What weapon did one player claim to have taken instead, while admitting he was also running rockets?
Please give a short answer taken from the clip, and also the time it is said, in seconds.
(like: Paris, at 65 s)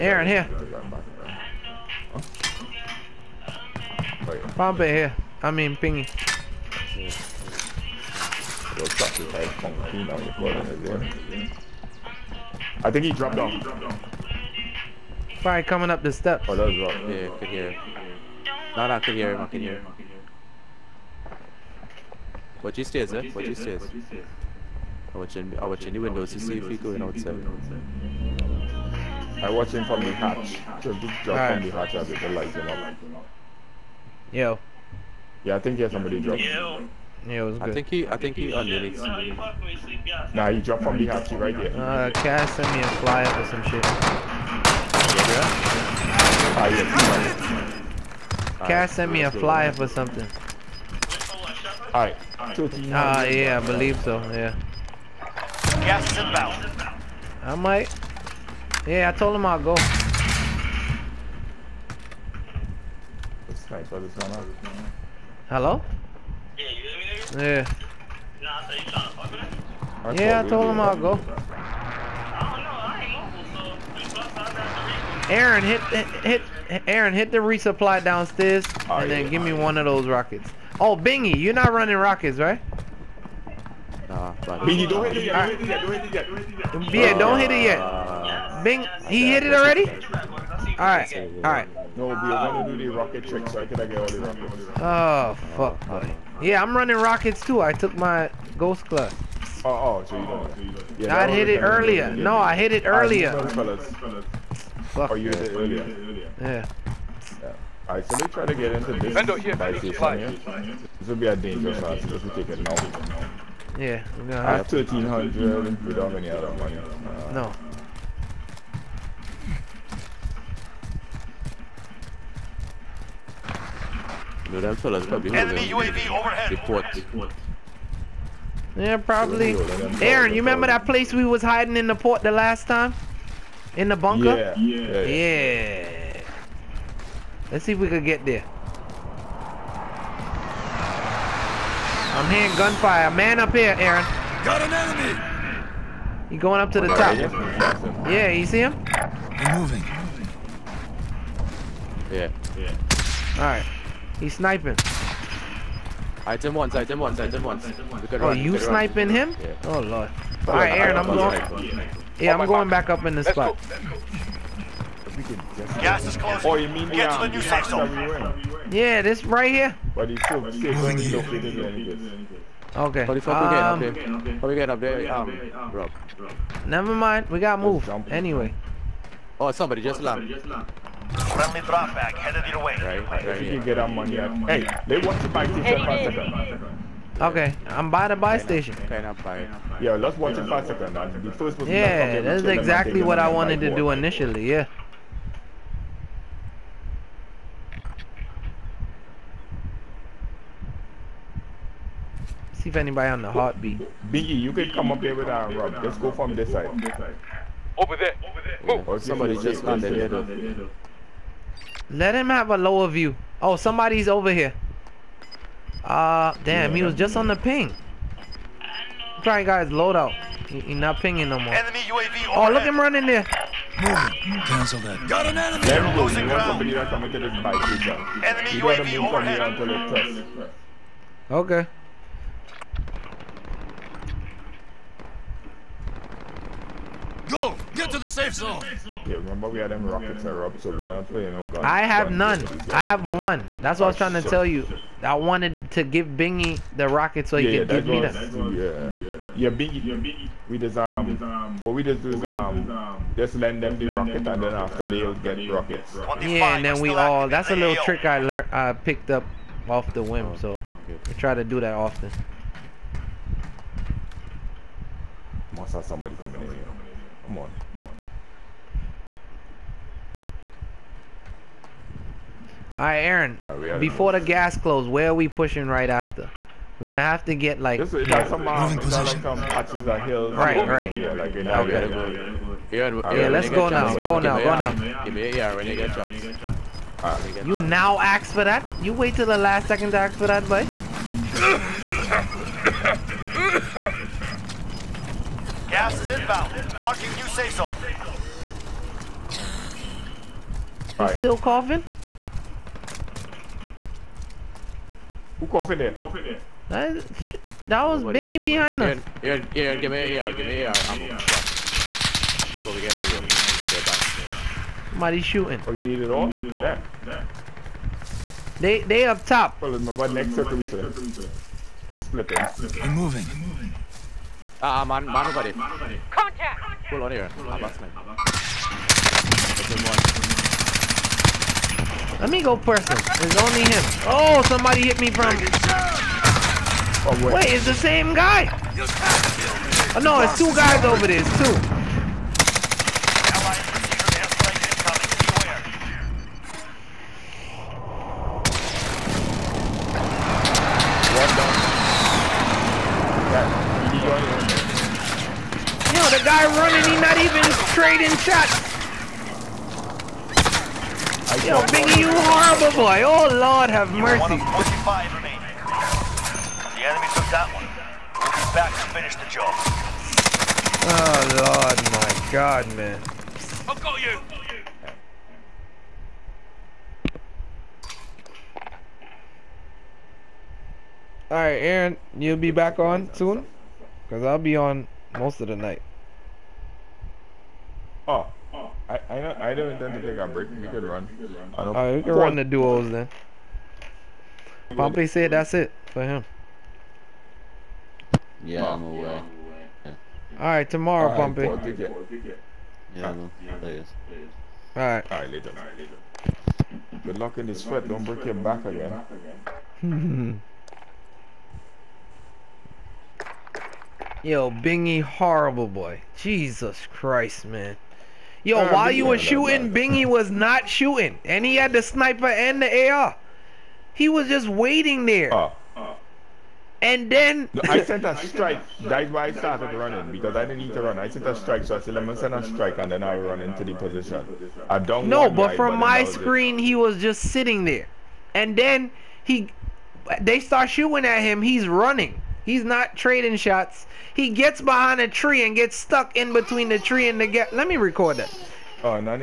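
Ghost club, at 98 s.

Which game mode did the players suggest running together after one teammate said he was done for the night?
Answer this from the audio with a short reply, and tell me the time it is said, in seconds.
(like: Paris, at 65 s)
Duos, at 392 s.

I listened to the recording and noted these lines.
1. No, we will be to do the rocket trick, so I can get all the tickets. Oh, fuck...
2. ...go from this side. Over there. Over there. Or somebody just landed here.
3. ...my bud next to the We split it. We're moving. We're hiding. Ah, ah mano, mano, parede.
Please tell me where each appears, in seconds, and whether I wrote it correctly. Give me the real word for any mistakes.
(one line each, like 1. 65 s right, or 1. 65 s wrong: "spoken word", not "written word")
1. 91 s wrong: "rockets", not "tickets"
2. 205 s right
3. 319 s wrong: "moving", not "hiding".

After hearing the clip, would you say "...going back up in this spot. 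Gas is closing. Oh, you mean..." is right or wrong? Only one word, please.
right.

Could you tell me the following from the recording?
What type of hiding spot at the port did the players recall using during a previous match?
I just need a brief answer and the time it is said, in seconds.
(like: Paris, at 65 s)
Bunker, at 133 s.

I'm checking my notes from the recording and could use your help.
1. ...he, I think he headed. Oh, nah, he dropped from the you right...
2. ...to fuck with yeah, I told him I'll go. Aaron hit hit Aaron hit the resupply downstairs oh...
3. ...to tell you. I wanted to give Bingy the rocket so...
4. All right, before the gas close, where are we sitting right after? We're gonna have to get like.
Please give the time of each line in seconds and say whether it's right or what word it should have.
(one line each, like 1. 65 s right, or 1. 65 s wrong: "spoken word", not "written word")
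1. 37 s wrong: "unmuted", not "headed"
2. 69 s right
3. 244 s right
4. 273 s wrong: "pushing", not "sitting".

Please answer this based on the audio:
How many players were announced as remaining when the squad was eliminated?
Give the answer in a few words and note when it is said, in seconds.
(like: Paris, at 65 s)
45, at 364 s.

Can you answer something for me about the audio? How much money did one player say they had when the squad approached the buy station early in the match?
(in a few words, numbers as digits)
1300.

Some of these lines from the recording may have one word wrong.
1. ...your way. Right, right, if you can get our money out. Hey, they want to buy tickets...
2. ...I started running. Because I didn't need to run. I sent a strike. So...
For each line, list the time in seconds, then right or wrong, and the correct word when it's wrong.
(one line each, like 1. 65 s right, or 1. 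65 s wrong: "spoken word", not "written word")
1. 182 s right
2. 429 s right.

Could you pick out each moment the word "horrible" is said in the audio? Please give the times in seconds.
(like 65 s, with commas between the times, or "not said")
362 s, 415 s.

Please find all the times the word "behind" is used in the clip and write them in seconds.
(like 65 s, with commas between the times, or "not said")
308 s, 444 s.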